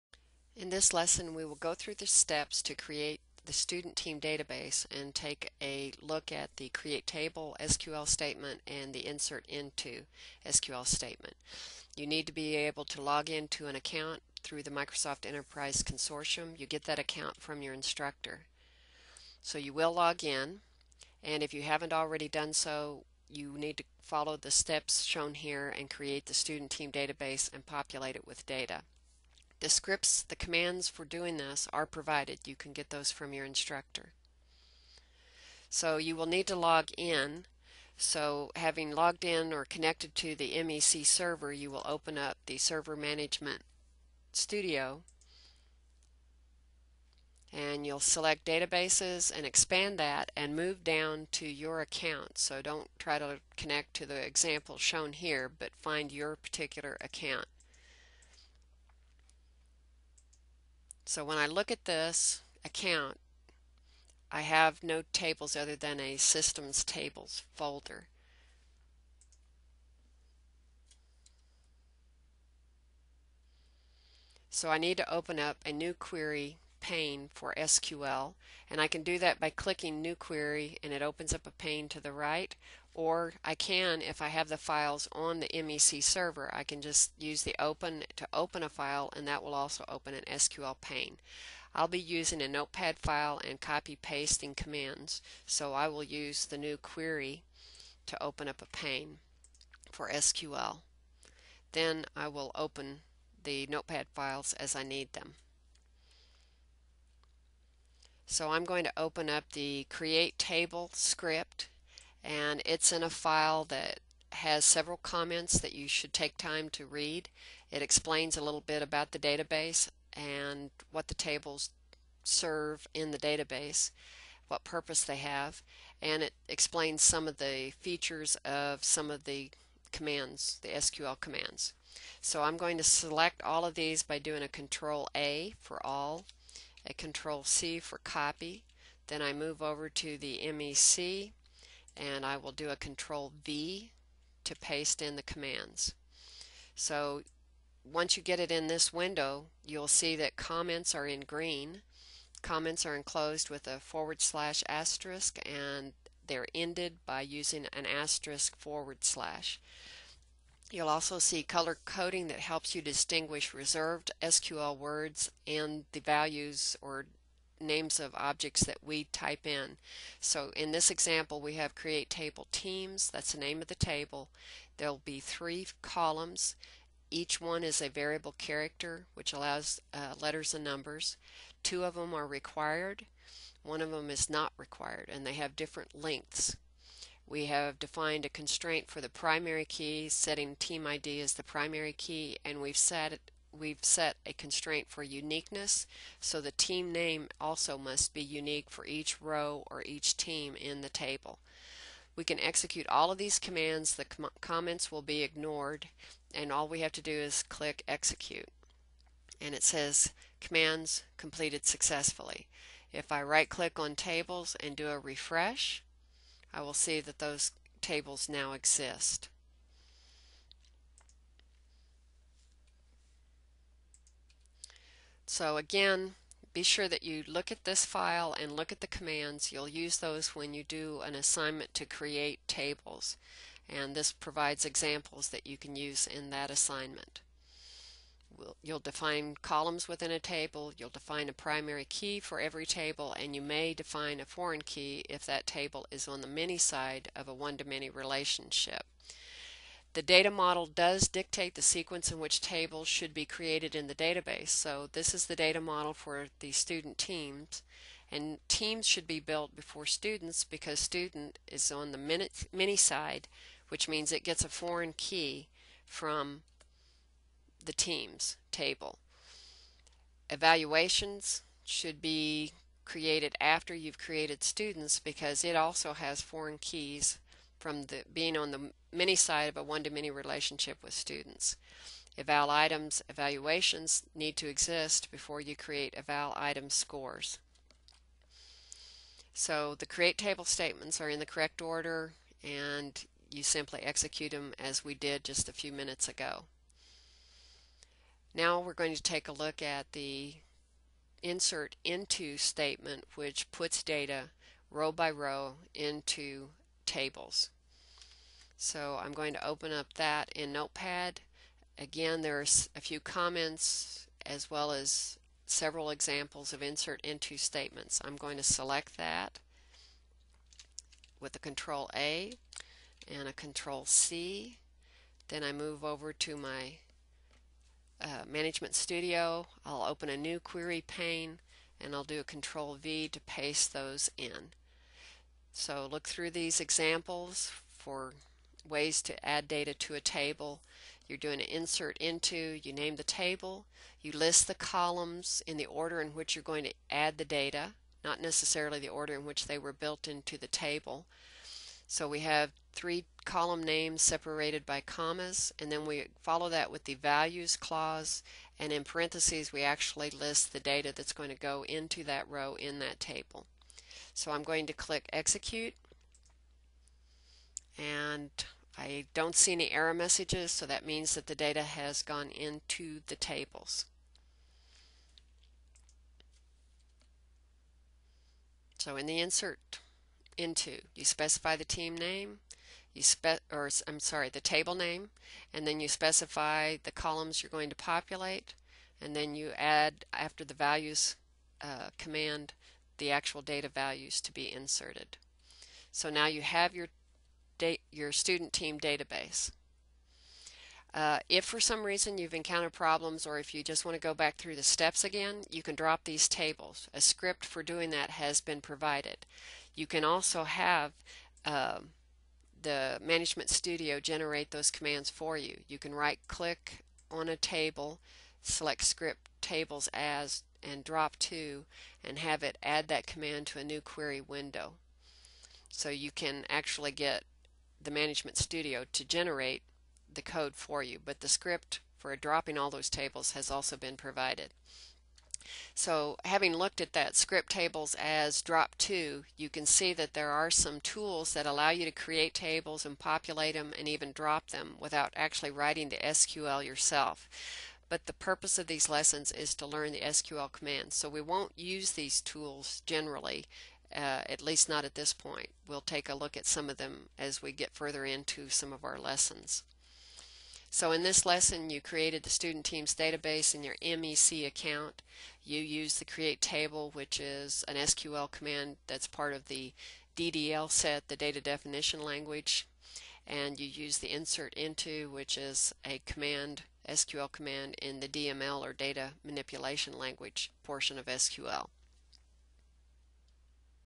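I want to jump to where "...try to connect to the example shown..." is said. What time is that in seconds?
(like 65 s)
52 s.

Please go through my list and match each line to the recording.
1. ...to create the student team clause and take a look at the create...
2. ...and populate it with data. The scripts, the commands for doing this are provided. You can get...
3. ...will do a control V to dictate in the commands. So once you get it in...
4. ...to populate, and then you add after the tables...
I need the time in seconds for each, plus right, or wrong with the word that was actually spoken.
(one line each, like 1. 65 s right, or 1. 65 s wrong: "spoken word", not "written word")
1. 2 s wrong: "database", not "clause"
2. 27 s right
3. 142 s wrong: "paste", not "dictate"
4. 387 s wrong: "values", not "tables".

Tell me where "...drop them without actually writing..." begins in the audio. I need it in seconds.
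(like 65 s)
444 s.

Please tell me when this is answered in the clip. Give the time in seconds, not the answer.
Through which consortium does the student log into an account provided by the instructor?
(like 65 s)
14 s.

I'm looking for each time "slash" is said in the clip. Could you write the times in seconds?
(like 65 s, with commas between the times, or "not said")
154 s, 159 s.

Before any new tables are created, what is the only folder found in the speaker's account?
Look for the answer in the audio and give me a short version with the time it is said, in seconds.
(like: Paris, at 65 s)
systems tables folder, at 66 s.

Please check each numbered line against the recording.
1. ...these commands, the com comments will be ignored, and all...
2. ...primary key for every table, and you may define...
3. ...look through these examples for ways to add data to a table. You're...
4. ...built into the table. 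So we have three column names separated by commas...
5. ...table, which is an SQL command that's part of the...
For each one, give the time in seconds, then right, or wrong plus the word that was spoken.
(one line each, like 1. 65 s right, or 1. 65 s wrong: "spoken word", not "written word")
1. 203 s right
2. 241 s right
3. 335 s right
4. 349 s right
5. 466 s right.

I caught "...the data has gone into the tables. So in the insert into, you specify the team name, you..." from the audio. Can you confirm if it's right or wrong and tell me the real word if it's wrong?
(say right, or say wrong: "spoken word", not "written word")
right.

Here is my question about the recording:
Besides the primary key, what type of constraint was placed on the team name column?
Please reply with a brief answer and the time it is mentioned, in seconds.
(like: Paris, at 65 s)
uniqueness, at 195 s.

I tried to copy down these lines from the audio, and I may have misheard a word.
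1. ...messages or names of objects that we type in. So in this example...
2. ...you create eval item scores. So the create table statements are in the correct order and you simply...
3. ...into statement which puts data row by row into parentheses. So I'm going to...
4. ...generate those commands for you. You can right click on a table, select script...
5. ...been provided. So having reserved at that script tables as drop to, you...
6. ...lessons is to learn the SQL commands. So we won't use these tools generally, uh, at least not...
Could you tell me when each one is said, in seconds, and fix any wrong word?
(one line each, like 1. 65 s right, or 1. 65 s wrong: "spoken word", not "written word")
1. 165 s wrong: "values", not "messages"
2. 285 s right
3. 301 s wrong: "tables", not "parentheses"
4. 413 s right
5. 433 s wrong: "looked", not "reserved"
6. 448 s right.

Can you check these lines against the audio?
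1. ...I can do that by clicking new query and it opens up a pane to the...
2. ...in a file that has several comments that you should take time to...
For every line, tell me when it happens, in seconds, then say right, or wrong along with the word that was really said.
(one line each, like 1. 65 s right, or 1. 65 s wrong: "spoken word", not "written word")
1. 78 s right
2. 112 s right.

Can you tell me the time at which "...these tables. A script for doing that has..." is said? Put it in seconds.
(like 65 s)
406 s.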